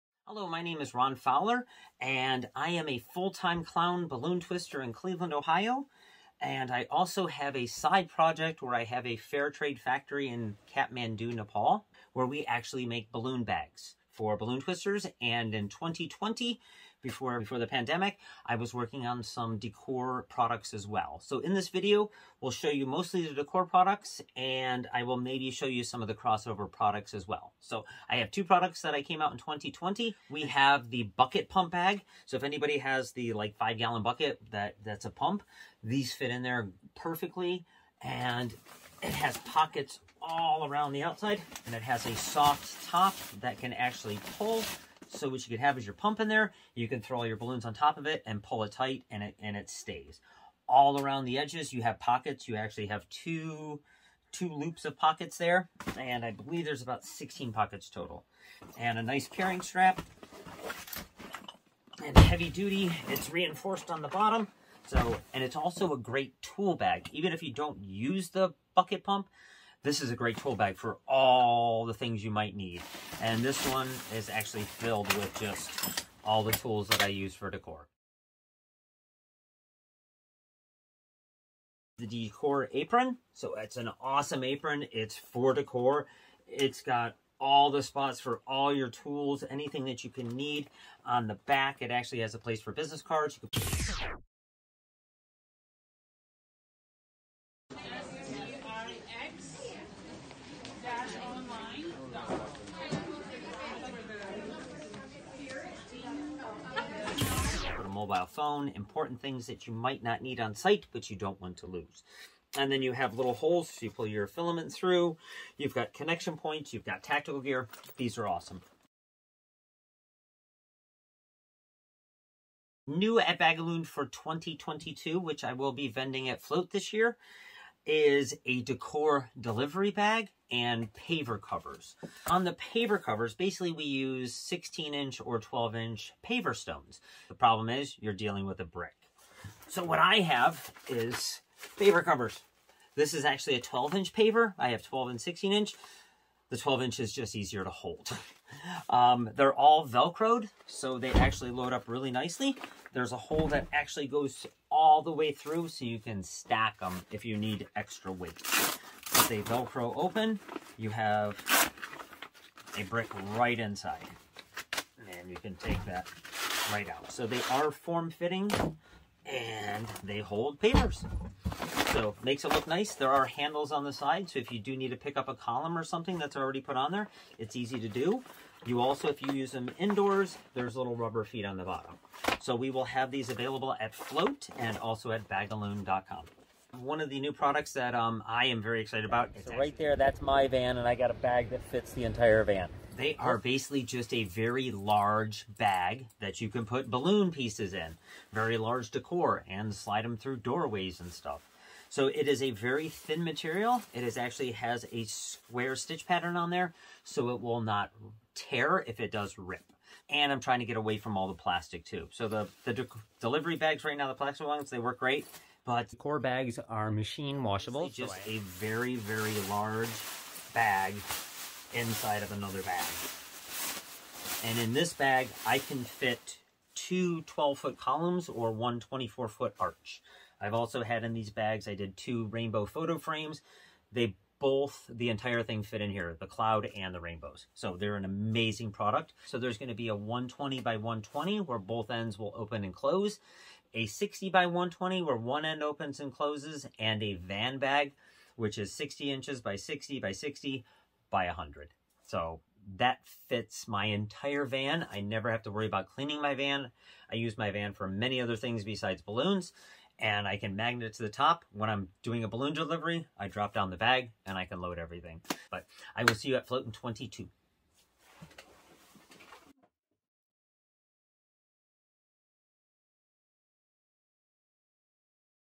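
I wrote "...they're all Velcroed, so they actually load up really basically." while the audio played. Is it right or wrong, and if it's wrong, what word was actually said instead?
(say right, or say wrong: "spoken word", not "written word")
wrong: "nicely", not "basically".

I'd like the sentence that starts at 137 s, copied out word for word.
The problem is you're dealing with a brick.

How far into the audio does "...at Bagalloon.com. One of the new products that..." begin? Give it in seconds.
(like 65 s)
185 s.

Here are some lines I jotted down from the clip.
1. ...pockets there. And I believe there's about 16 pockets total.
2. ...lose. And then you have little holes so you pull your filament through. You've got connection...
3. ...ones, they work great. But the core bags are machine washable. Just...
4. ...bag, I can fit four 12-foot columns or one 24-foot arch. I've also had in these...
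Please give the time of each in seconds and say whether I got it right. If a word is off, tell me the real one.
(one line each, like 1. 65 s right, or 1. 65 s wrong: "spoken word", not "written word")
1. 54 s right
2. 111 s right
3. 214 s right
4. 224 s wrong: "two", not "four".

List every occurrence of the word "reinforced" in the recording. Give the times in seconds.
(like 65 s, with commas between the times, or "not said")
63 s.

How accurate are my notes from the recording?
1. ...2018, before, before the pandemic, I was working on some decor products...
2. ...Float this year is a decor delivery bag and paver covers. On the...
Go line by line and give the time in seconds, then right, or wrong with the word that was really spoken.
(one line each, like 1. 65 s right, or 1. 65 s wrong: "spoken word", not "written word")
1. 15 s wrong: "2020", not "2018"
2. 126 s right.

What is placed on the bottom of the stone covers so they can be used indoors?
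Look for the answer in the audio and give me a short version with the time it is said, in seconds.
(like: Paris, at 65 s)
rubber feet, at 180 s.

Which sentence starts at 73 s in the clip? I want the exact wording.
And this one is actually filled with just all the tools that I use for decor.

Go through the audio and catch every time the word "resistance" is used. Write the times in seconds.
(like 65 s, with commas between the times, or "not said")
not said.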